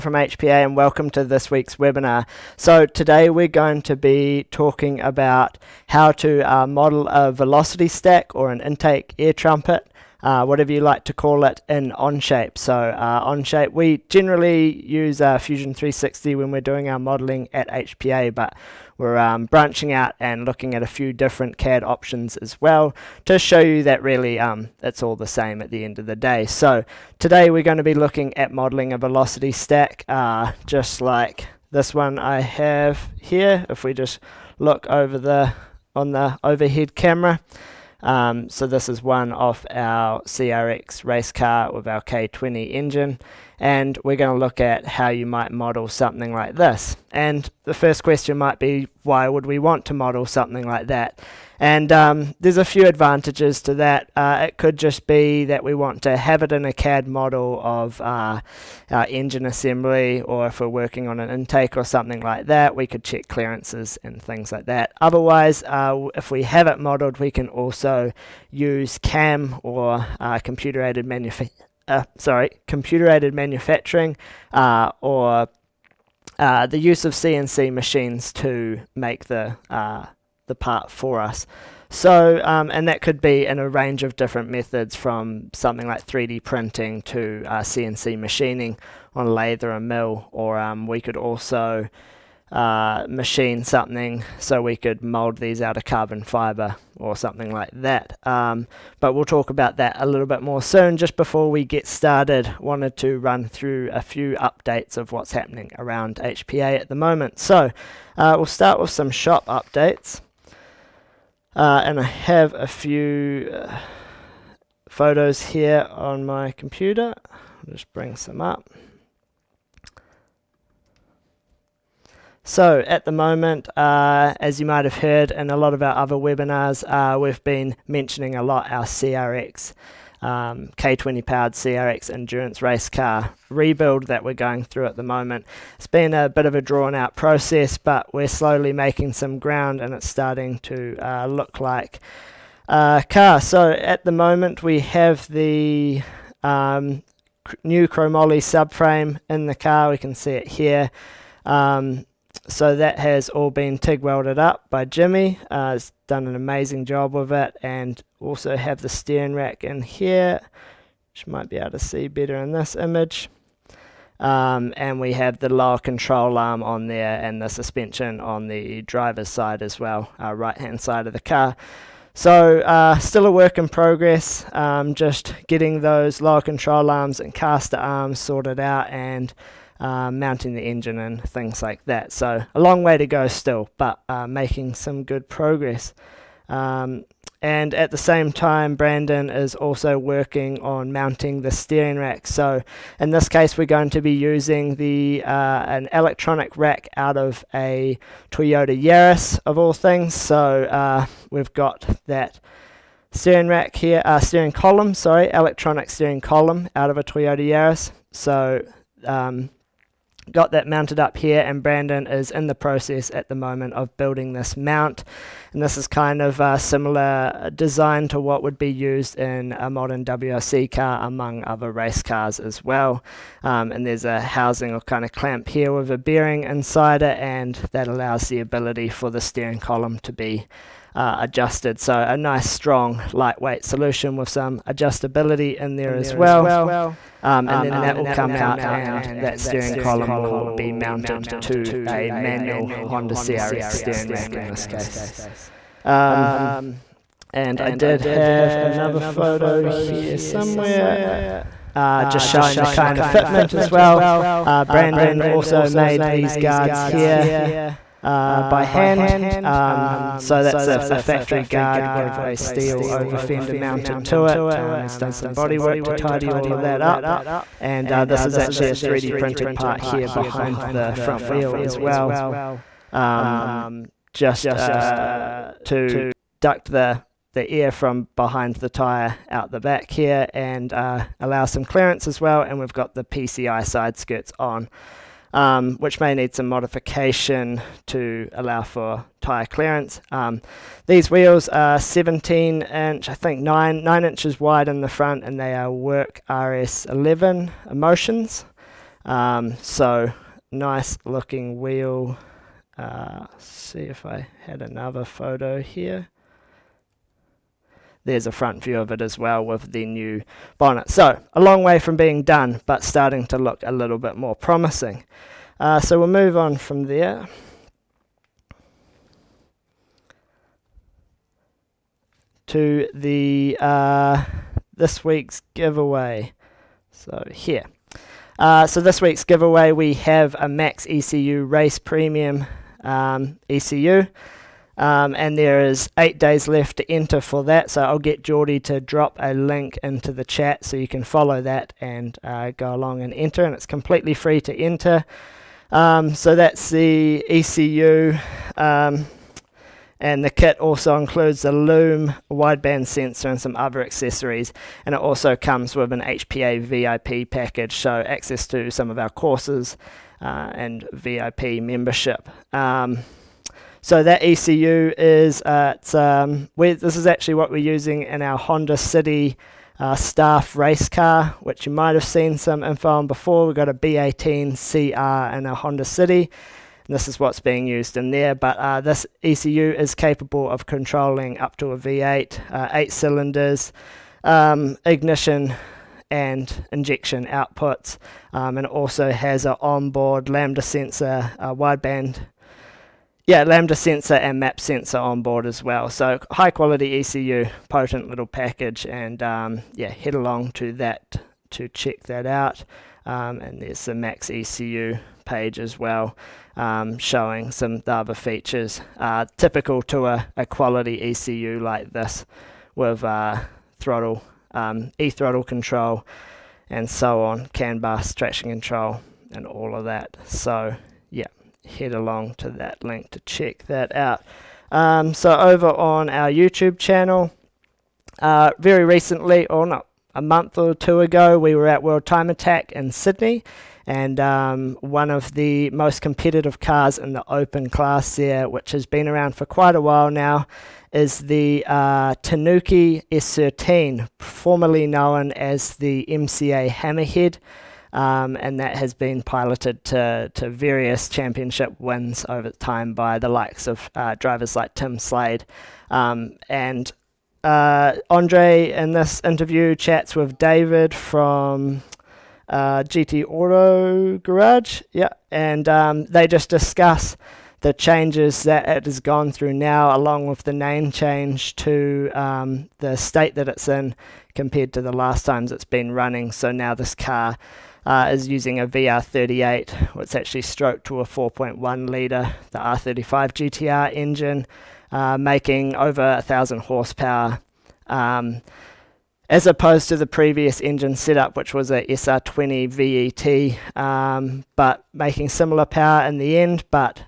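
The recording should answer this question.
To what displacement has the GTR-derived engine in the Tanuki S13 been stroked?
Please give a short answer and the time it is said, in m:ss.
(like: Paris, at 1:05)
4.1 litre, at 8:01.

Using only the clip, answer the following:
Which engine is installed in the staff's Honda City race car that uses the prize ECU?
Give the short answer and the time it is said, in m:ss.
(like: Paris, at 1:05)
B18CR, at 6:13.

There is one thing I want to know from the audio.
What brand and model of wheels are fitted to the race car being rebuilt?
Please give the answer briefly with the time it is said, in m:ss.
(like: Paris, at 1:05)
Work RS11 Emotions, at 4:55.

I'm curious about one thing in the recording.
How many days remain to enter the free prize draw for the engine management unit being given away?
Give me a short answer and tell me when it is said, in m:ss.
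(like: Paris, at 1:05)
8, at 5:35.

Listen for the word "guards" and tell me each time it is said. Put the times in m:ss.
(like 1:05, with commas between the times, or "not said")
4:16, 4:21.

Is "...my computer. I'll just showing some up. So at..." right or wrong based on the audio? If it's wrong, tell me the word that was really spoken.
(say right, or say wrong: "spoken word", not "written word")
wrong: "bring", not "showing".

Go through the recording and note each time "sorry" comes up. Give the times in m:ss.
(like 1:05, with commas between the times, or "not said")
1:12, 3:24.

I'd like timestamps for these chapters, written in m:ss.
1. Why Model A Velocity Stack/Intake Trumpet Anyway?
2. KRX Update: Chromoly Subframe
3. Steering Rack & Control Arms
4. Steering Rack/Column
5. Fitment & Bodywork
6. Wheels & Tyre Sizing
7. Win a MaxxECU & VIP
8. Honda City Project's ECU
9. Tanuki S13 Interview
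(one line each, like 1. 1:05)
1. 0:49
2. 1:56
3. 2:44
4. 3:08
5. 4:11
6. 4:52
7. 5:17
8. 6:09
9. 7:07.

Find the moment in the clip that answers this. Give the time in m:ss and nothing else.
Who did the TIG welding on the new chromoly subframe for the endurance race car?
2:34.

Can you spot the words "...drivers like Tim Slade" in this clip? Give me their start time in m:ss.
7:34.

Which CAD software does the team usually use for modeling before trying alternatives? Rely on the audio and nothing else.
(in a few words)
Fusion 360.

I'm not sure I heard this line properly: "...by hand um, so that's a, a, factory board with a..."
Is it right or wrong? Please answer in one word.
wrong.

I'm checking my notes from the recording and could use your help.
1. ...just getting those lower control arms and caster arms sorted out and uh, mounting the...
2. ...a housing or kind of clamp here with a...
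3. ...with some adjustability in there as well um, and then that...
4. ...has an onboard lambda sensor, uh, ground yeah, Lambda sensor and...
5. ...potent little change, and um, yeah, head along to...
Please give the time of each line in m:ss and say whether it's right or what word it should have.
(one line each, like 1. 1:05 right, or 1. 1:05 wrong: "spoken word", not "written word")
1. 2:54 right
2. 3:44 right
3. 3:54 right
4. 6:29 wrong: "wideband", not "ground"
5. 6:37 wrong: "package", not "change".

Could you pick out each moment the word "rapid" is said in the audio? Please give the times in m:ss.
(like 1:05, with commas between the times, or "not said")
not said.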